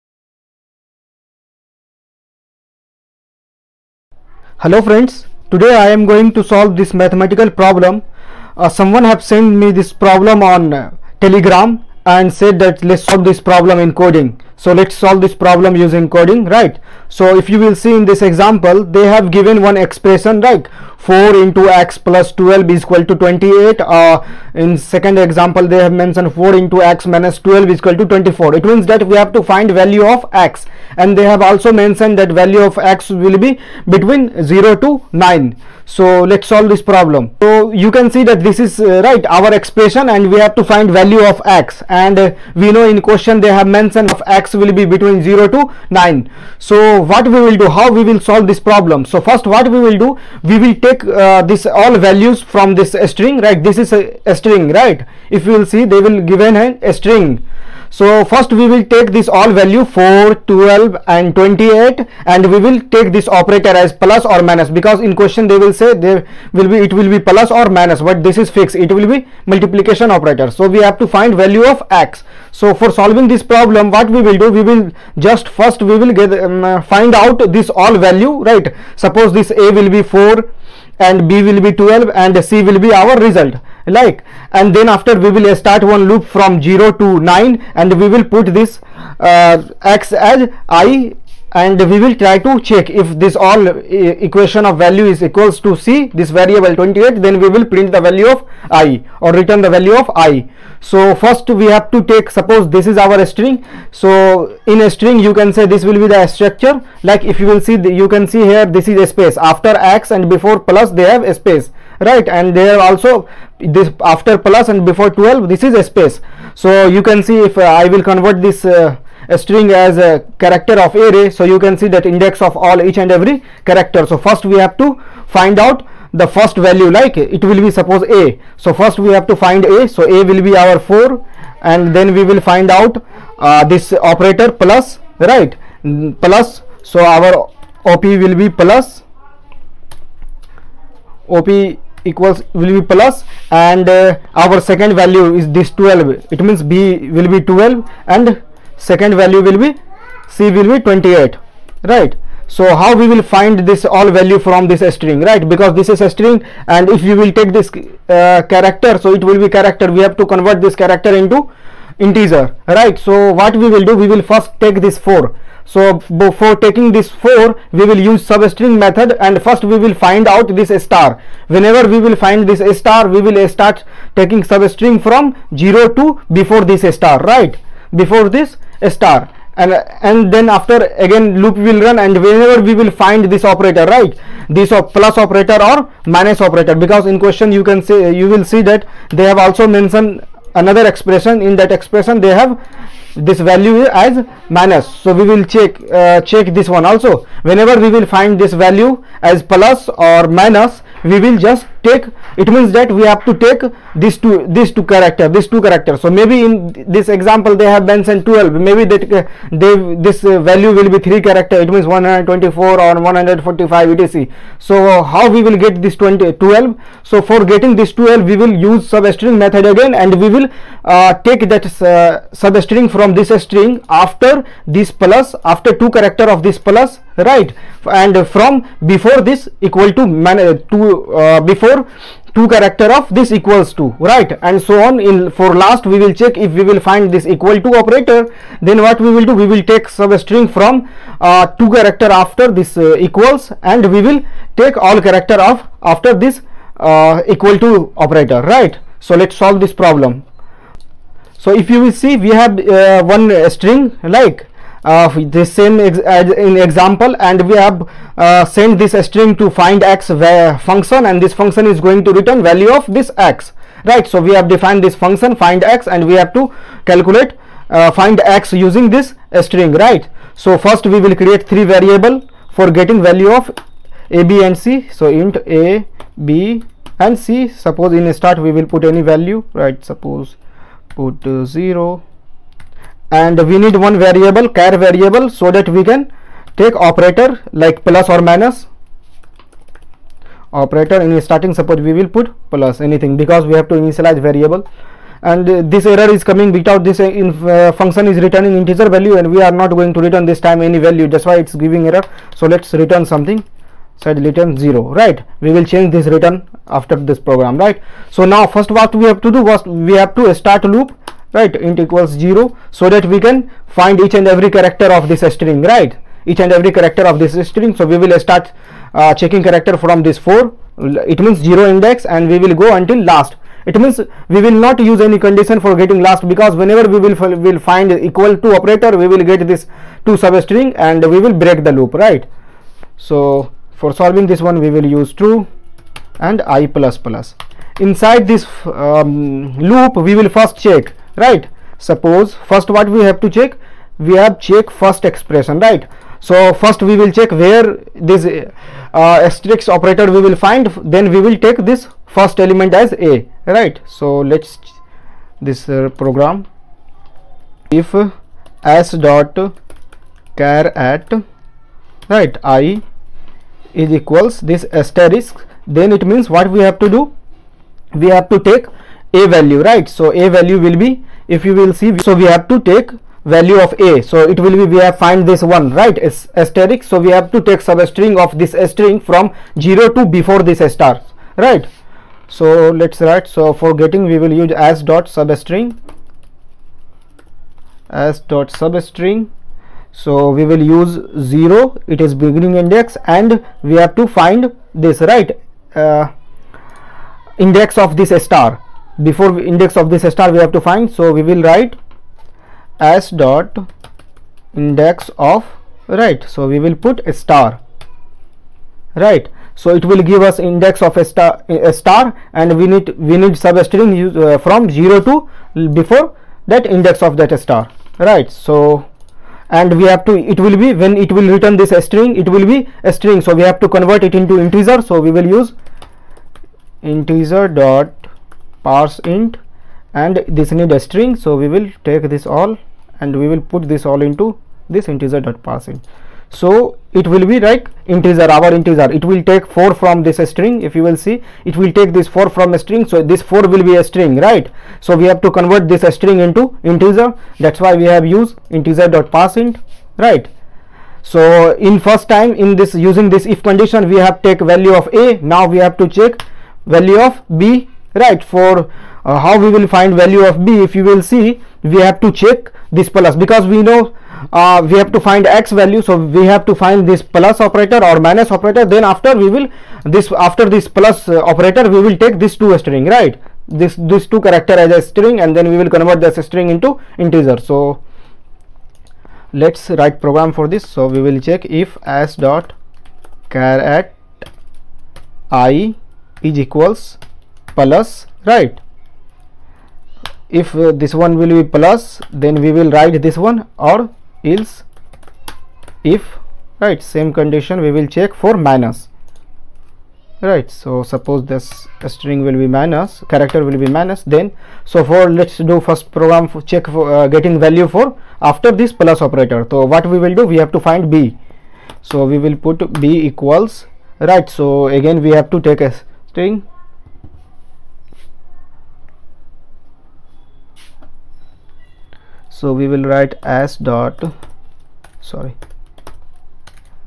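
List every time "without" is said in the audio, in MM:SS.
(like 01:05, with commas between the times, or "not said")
04:56.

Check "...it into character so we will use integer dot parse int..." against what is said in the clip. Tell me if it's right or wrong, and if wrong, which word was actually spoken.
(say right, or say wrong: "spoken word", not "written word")
wrong: "integer", not "character".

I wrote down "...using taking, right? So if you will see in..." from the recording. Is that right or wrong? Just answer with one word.
wrong.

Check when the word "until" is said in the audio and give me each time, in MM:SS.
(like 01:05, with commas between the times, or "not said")
05:22.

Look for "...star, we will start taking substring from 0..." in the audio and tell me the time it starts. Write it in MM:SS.
02:52.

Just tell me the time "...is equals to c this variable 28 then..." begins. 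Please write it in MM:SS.
01:35.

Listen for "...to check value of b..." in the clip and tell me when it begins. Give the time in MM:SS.
07:35.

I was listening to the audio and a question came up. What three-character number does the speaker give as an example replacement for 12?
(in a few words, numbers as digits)
124.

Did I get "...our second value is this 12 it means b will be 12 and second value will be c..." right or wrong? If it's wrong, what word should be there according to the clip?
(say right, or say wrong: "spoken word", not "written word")
right.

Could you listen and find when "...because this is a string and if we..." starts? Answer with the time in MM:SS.
02:35.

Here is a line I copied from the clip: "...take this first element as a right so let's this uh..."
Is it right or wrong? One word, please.
right.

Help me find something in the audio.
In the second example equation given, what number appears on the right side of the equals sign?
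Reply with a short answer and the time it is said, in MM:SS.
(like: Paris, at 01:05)
24, at 00:28.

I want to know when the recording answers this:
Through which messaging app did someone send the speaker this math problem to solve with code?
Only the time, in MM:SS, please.
00:11.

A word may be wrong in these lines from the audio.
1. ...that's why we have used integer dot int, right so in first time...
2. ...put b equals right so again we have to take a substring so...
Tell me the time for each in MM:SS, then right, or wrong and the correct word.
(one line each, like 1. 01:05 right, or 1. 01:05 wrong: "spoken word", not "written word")
1. 07:27 right
2. 08:32 wrong: "string", not "substring".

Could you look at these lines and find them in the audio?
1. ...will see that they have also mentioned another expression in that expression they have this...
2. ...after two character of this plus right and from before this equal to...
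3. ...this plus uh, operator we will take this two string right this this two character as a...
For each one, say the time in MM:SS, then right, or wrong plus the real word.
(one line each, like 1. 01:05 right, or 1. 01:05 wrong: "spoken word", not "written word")
1. 03:08 right
2. 03:45 right
3. 07:50 right.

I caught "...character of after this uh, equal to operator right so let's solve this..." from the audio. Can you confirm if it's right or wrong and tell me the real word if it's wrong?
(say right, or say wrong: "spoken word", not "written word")
right.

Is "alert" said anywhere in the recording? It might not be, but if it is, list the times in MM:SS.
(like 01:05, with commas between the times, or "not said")
not said.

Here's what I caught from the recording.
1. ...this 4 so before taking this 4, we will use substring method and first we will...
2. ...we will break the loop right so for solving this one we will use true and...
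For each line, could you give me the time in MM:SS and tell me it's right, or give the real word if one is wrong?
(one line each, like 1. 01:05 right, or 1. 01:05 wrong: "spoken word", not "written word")
1. 02:44 right
2. 05:31 right.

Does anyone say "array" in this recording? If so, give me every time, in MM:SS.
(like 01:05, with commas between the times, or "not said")
02:00.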